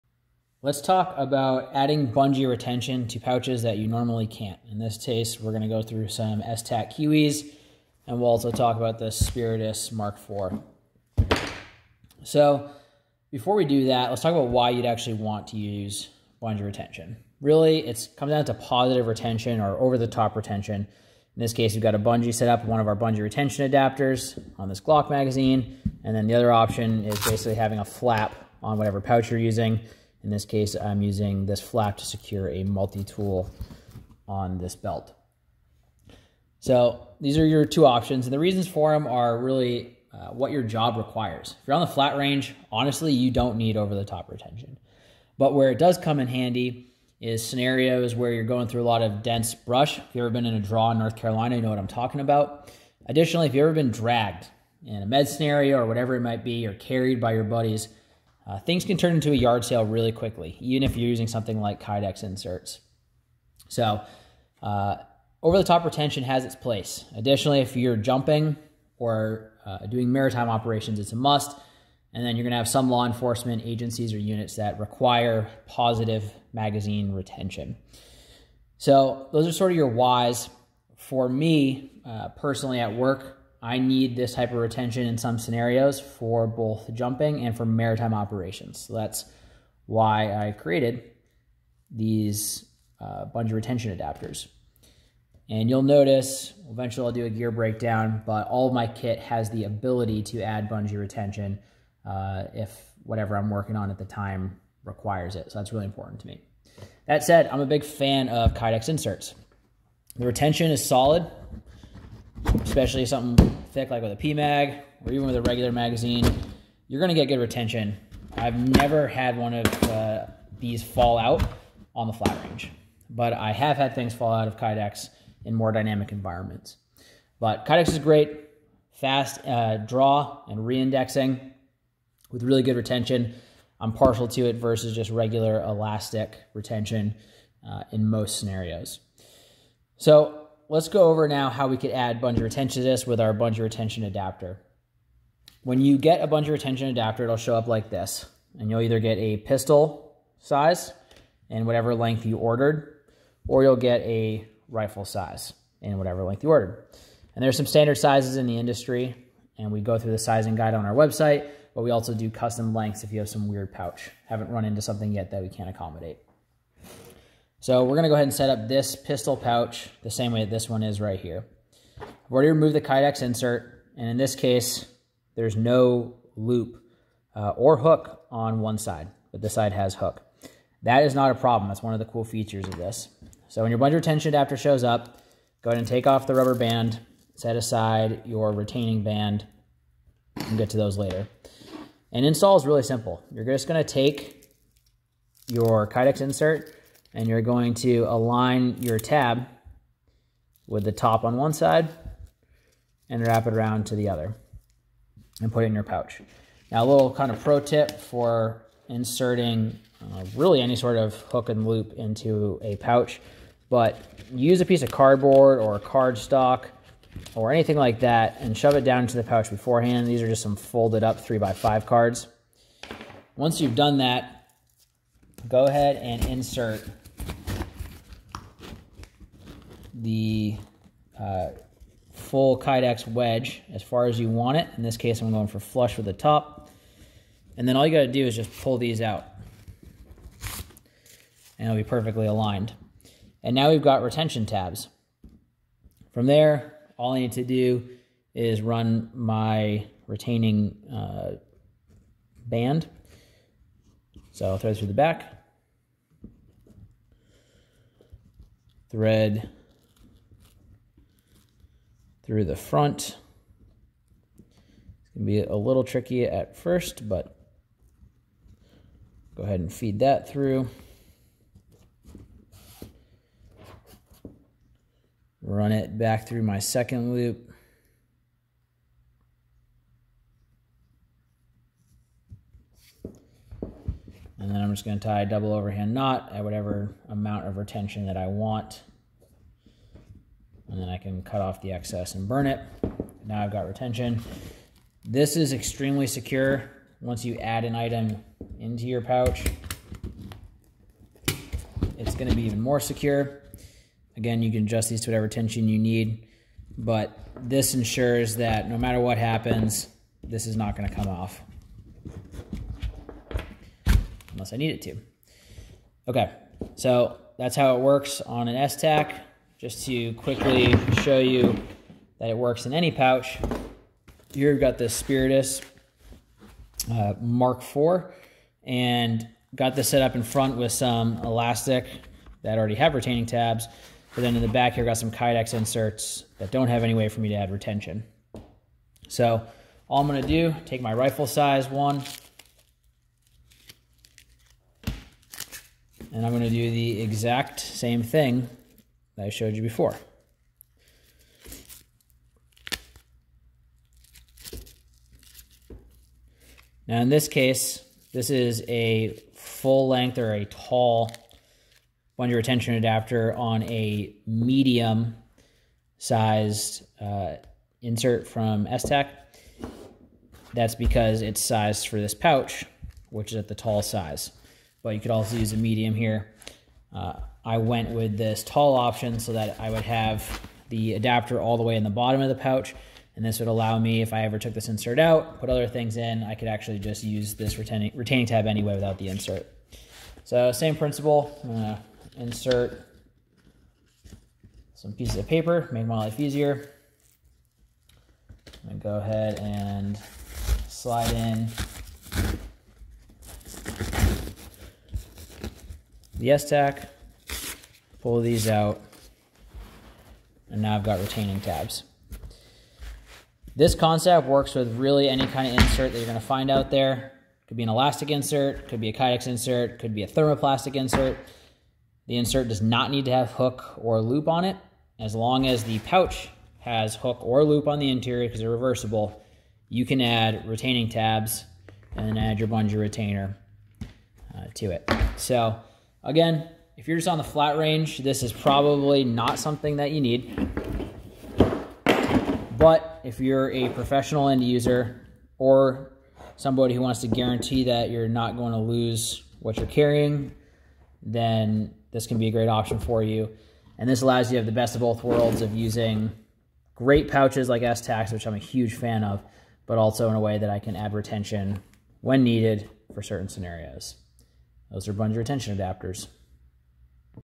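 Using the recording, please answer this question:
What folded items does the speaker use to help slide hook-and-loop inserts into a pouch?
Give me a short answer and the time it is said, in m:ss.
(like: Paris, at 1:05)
Three by five cards, at 3:41.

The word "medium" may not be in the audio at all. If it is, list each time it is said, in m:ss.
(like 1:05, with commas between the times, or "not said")
6:04, 6:15.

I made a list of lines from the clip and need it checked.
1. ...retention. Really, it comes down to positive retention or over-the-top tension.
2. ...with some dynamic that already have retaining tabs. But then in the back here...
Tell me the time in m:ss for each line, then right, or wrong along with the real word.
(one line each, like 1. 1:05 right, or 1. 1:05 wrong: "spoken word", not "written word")
1. 0:16 wrong: "retention", not "tension"
2. 5:30 wrong: "elastic", not "dynamic".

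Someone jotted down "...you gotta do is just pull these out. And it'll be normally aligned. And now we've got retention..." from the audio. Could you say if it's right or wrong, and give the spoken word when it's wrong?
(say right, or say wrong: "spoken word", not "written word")
wrong: "perfectly", not "normally".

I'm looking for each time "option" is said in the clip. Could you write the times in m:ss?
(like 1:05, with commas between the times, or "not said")
0:26, 0:37, 6:18, 7:32.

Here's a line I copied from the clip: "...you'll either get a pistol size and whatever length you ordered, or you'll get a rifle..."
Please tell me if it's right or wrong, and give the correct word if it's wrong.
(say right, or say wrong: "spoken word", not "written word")
right.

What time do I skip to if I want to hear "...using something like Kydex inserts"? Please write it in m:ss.
1:01.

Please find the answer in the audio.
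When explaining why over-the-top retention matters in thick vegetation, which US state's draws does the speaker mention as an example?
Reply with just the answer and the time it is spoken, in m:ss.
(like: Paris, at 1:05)
North Carolina, at 0:50.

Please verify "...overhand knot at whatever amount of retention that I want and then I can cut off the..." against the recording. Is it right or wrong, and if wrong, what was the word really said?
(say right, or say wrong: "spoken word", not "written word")
right.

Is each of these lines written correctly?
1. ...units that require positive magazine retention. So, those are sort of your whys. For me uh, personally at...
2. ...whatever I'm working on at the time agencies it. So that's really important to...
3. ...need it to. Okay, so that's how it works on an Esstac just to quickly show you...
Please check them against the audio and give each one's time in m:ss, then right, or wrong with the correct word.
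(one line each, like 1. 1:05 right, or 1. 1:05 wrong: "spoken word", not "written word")
1. 1:14 right
2. 1:43 wrong: "requires", not "agencies"
3. 5:14 right.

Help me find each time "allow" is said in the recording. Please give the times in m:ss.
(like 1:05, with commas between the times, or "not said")
6:23, 7:34.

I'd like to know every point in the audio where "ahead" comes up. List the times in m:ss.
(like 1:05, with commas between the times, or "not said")
2:48, 3:05, 3:45, 4:29, 6:39.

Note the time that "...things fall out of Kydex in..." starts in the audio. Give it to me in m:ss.
2:03.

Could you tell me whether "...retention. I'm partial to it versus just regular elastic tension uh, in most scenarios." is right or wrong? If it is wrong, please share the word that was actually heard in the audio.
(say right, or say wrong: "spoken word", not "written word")
wrong: "retention", not "tension".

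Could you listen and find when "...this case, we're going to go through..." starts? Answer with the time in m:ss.
0:04.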